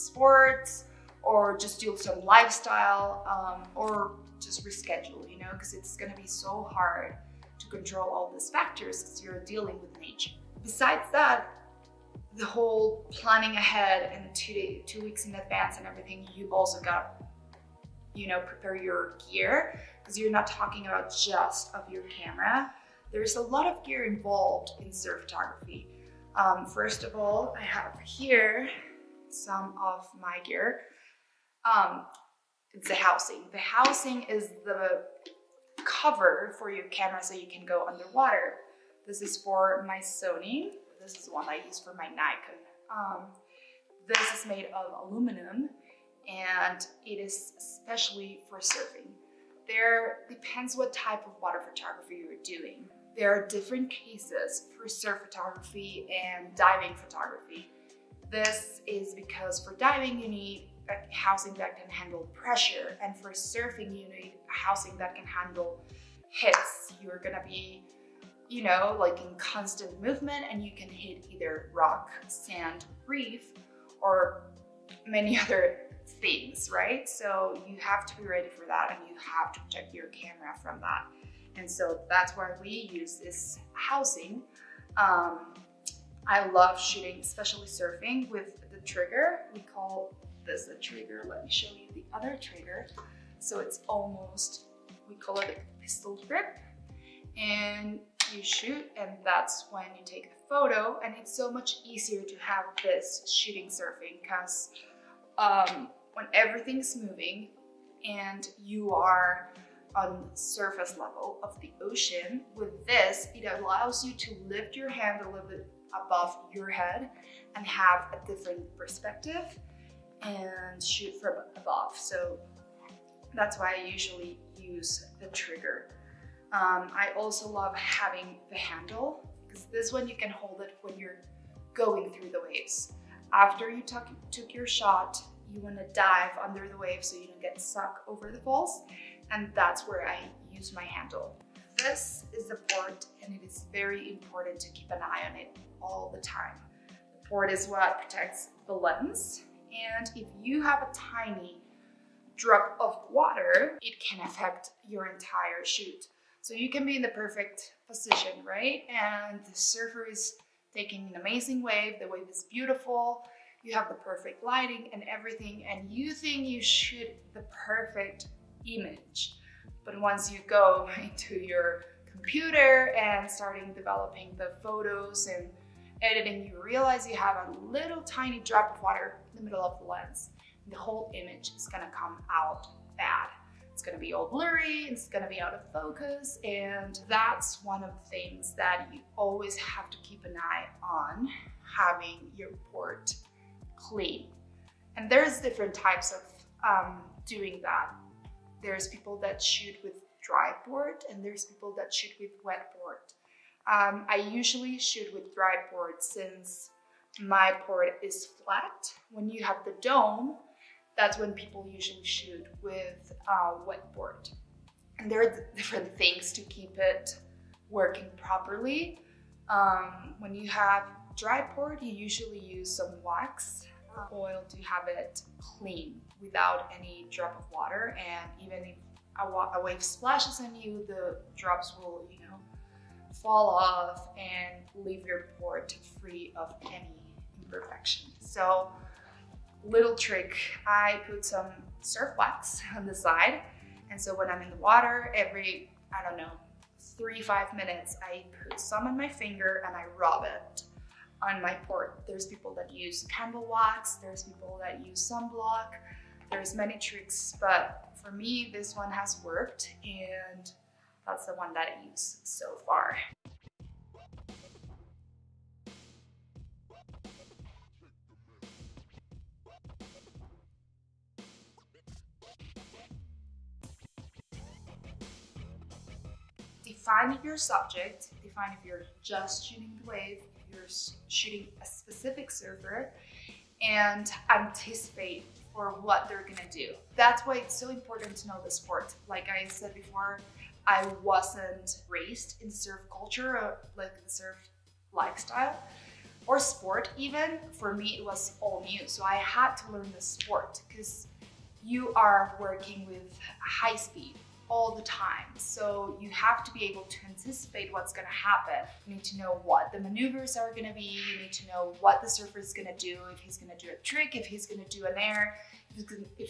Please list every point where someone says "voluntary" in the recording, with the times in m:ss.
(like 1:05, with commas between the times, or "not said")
not said.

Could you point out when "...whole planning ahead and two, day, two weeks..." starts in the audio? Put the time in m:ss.
0:12.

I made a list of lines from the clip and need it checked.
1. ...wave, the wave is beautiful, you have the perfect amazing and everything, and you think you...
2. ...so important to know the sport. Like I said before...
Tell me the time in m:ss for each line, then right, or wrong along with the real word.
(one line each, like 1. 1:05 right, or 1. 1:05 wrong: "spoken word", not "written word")
1. 2:41 wrong: "lighting", not "amazing"
2. 4:47 right.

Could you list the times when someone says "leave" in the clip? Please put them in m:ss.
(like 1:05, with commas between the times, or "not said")
3:54.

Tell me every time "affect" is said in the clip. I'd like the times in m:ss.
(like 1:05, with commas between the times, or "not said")
2:34.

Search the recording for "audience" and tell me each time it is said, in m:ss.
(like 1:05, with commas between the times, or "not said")
not said.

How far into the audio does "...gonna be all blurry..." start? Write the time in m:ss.
3:03.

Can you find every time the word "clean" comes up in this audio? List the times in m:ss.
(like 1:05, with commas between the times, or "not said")
3:13, 3:45.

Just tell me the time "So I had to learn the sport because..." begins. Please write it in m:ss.
4:58.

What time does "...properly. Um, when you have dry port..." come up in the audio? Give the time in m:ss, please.
3:38.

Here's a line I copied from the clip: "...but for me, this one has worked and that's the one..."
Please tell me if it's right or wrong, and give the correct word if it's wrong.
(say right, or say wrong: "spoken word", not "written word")
right.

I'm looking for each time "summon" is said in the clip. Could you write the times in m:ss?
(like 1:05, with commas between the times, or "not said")
not said.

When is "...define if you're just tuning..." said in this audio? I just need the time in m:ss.
4:38.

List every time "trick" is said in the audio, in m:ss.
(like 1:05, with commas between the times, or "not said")
3:59, 4:16, 5:13.